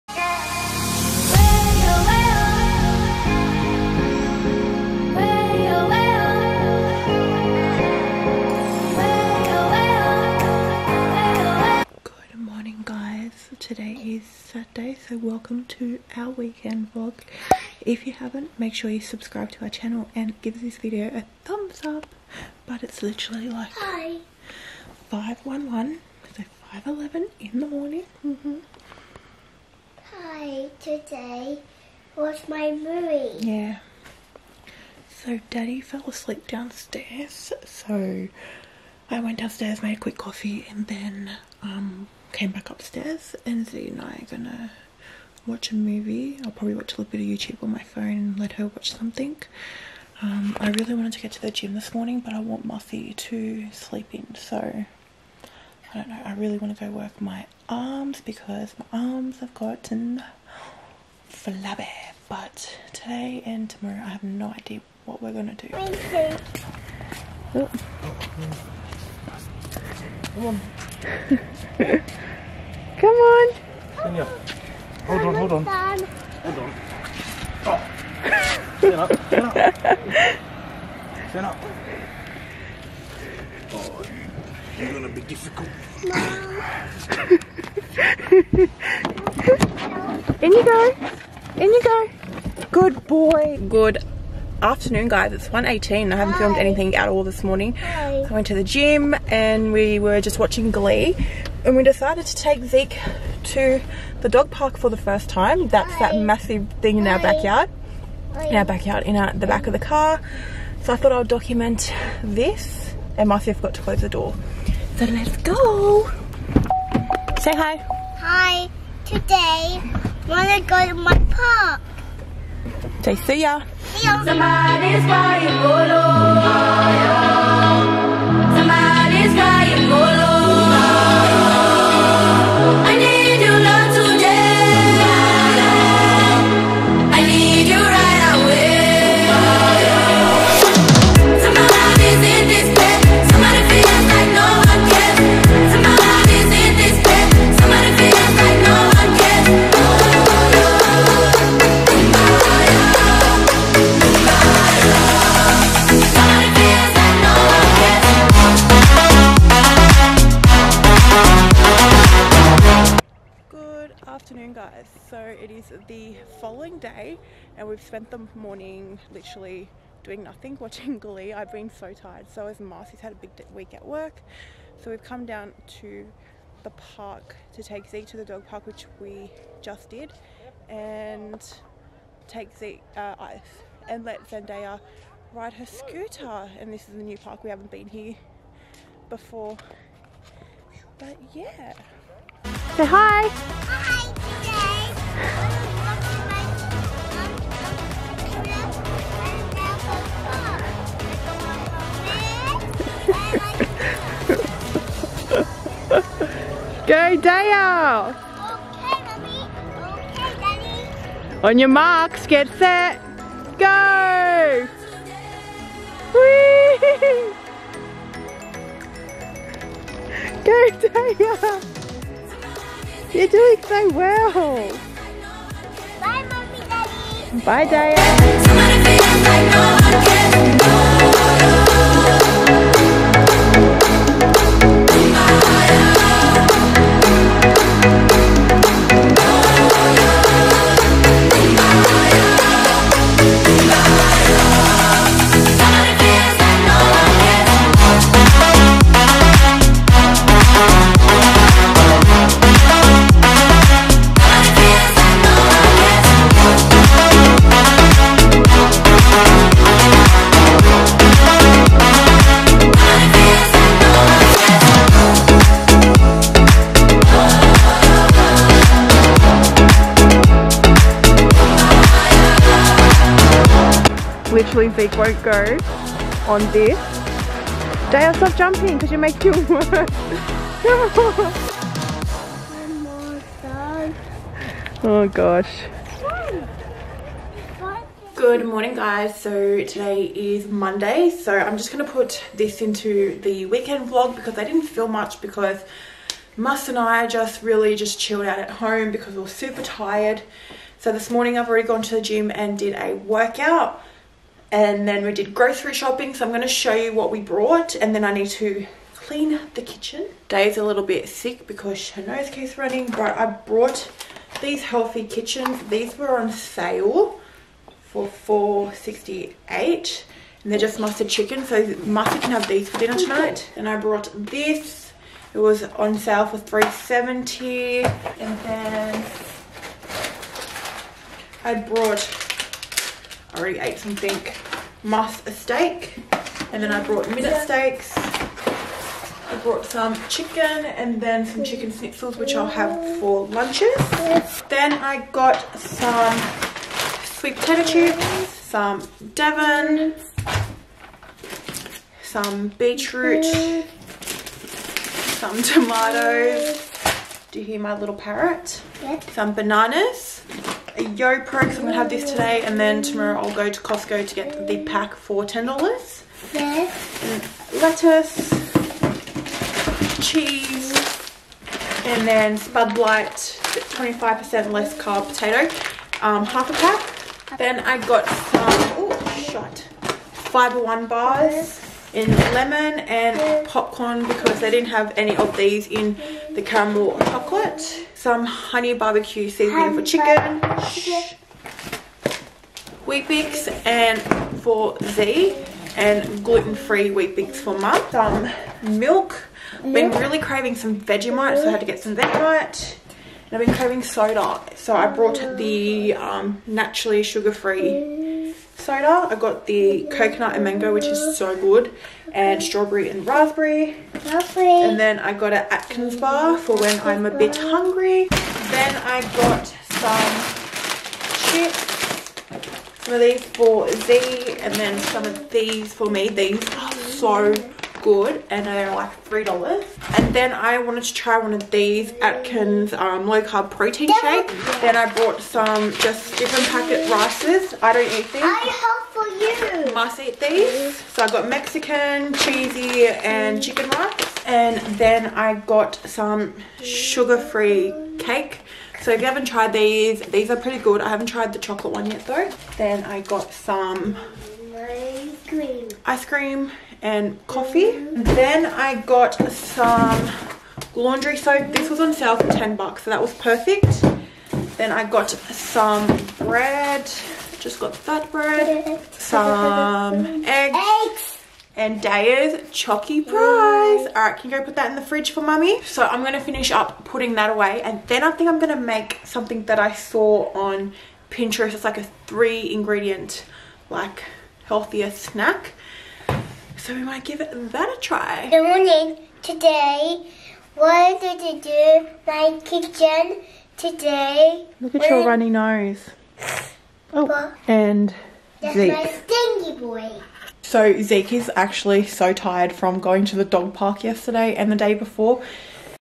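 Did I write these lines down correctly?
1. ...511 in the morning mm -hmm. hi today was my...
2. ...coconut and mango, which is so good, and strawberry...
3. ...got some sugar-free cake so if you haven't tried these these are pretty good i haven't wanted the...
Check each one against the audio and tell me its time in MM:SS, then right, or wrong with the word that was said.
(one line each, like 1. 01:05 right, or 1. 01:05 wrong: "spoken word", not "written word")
1. 00:26 right
2. 06:49 right
3. 07:25 wrong: "tried", not "wanted".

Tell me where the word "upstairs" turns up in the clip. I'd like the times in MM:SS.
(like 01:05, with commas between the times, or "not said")
00:42.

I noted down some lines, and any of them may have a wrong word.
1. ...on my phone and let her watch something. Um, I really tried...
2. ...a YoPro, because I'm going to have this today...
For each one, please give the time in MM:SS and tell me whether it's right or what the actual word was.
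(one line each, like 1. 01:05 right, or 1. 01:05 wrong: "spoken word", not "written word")
1. 00:47 wrong: "wanted", not "tried"
2. 06:00 right.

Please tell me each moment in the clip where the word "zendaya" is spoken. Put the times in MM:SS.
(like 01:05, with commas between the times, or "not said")
03:04.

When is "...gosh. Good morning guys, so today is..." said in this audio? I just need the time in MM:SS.
04:45.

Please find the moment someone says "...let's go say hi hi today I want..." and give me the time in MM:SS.
01:55.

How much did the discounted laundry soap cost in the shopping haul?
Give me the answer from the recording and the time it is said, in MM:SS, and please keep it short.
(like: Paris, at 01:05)
$10, at 07:42.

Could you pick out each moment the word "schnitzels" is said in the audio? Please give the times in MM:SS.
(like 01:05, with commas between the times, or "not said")
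05:41.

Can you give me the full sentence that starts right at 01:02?
But today and tomorrow, I have no idea what we're gonna do.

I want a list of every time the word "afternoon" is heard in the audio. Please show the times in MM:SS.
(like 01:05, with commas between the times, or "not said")
01:34, 02:44.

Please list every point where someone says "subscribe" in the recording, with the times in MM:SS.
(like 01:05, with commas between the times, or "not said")
00:18.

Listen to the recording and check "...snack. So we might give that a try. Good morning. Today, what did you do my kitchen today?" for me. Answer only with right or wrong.
right.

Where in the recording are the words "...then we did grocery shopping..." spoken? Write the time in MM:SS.
05:04.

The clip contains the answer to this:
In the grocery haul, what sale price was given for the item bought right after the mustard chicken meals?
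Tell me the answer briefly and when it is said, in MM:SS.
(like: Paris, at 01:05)
$3.70, at 05:26.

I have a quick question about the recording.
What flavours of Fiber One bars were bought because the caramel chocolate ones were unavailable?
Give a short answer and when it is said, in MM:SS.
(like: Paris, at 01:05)
lemon and popcorn, at 06:22.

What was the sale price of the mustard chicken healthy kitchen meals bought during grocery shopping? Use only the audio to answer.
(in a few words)
$4.68.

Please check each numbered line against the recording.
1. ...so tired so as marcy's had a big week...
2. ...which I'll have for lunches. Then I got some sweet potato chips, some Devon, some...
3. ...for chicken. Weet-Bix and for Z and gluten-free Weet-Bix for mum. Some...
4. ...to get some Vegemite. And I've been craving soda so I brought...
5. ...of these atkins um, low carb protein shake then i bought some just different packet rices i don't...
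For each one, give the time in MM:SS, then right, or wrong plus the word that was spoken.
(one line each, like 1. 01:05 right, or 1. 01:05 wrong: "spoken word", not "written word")
1. 02:51 right
2. 05:42 right
3. 06:29 right
4. 06:41 right
5. 07:11 right.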